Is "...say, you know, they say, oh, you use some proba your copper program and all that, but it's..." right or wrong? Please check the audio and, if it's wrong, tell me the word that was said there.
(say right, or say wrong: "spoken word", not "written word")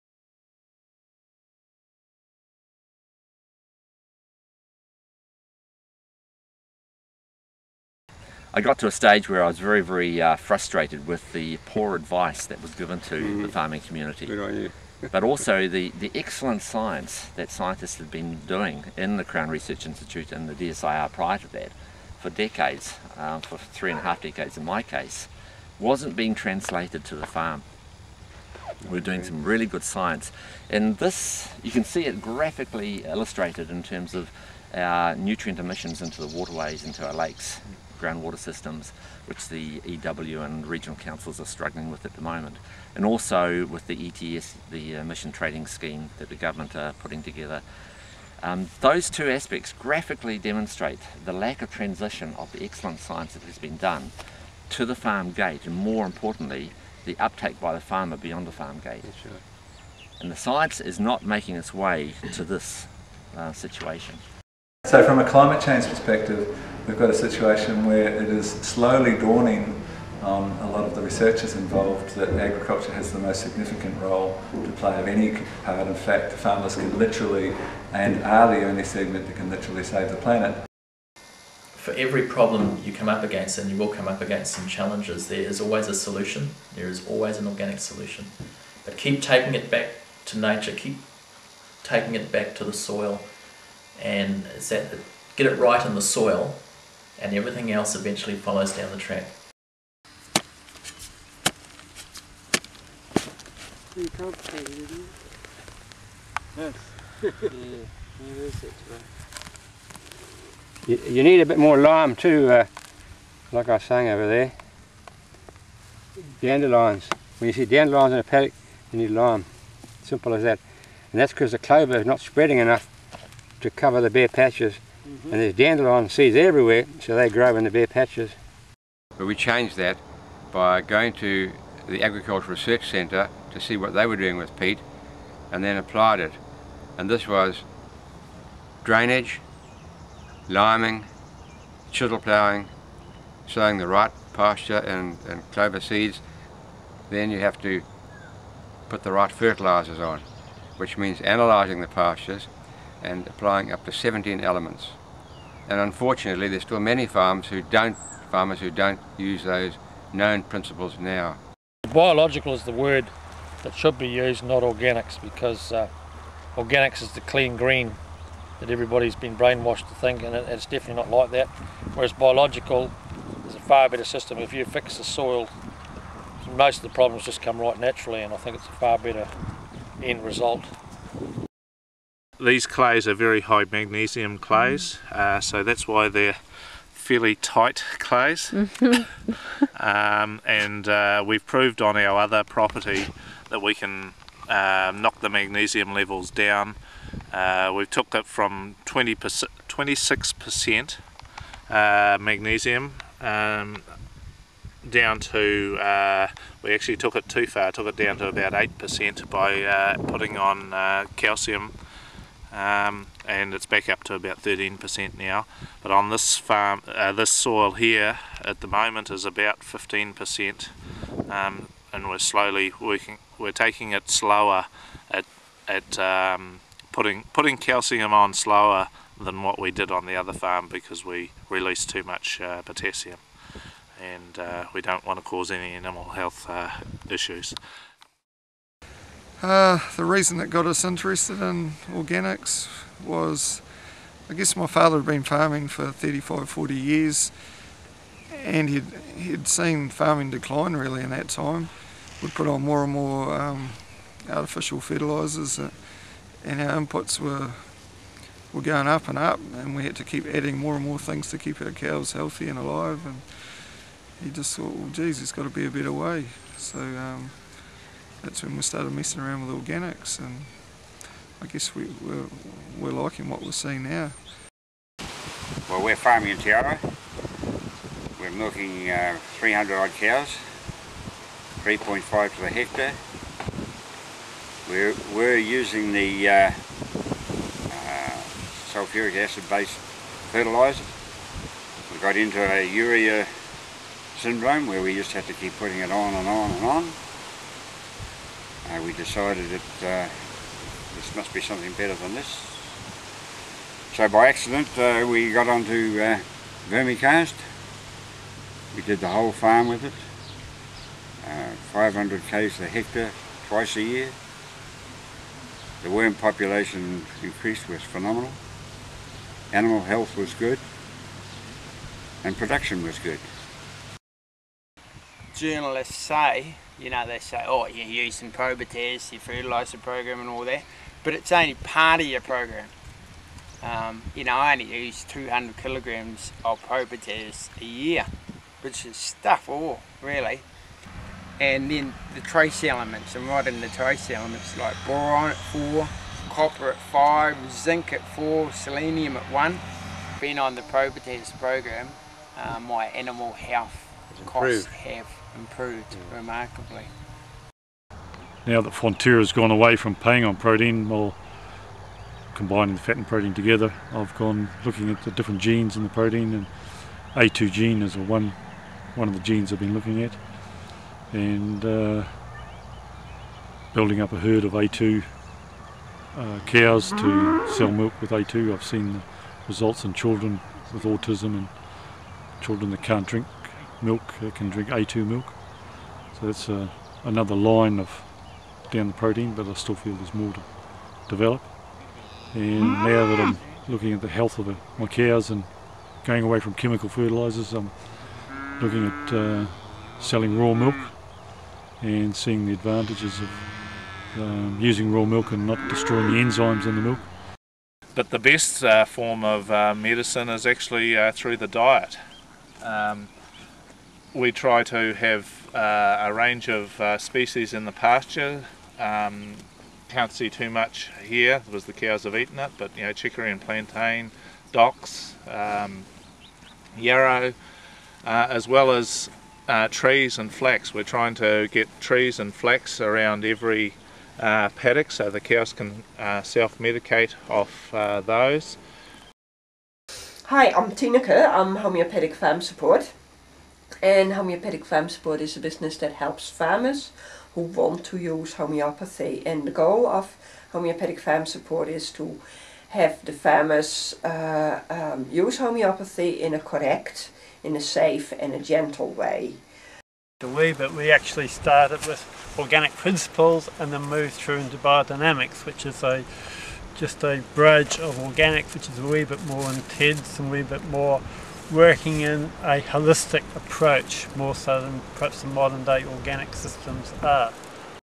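wrong: "fertiliser", not "copper".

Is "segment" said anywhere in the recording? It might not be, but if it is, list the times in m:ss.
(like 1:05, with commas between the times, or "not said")
1:18.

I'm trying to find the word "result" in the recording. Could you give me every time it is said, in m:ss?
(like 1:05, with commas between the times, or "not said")
3:00, 6:19.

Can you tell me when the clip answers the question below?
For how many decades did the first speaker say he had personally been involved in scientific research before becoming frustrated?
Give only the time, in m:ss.
0:23.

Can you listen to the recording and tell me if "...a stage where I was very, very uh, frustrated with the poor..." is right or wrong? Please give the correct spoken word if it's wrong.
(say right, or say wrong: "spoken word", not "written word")
right.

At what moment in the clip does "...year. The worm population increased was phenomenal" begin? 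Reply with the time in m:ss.
5:13.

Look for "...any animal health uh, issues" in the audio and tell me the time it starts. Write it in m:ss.
3:55.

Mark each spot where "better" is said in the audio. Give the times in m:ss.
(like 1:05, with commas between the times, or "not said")
2:53, 2:58, 4:25, 5:01.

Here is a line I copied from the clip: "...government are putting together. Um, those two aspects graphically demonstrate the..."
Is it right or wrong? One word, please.
right.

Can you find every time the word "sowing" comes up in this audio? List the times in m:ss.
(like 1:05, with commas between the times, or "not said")
2:23.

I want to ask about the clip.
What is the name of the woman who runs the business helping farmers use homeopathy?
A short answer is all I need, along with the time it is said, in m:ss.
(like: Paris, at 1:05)
Tina Kerr, at 7:20.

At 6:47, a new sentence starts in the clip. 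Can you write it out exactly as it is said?
But the best uh, form of uh, medicine is actually uh, through the diet.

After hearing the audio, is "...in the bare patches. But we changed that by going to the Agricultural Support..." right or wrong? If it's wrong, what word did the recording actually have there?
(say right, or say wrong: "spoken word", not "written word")
wrong: "Research", not "Support".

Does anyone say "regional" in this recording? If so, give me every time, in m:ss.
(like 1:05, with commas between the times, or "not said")
0:40.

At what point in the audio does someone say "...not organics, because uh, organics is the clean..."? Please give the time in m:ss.
2:44.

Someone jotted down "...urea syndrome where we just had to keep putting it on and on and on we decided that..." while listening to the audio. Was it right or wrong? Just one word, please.
right.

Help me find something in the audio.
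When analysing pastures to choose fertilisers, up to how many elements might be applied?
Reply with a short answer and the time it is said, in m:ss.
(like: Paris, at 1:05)
17, at 2:33.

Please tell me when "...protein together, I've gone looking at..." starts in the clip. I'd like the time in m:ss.
6:03.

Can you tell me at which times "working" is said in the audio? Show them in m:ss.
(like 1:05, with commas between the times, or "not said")
3:42, 7:51.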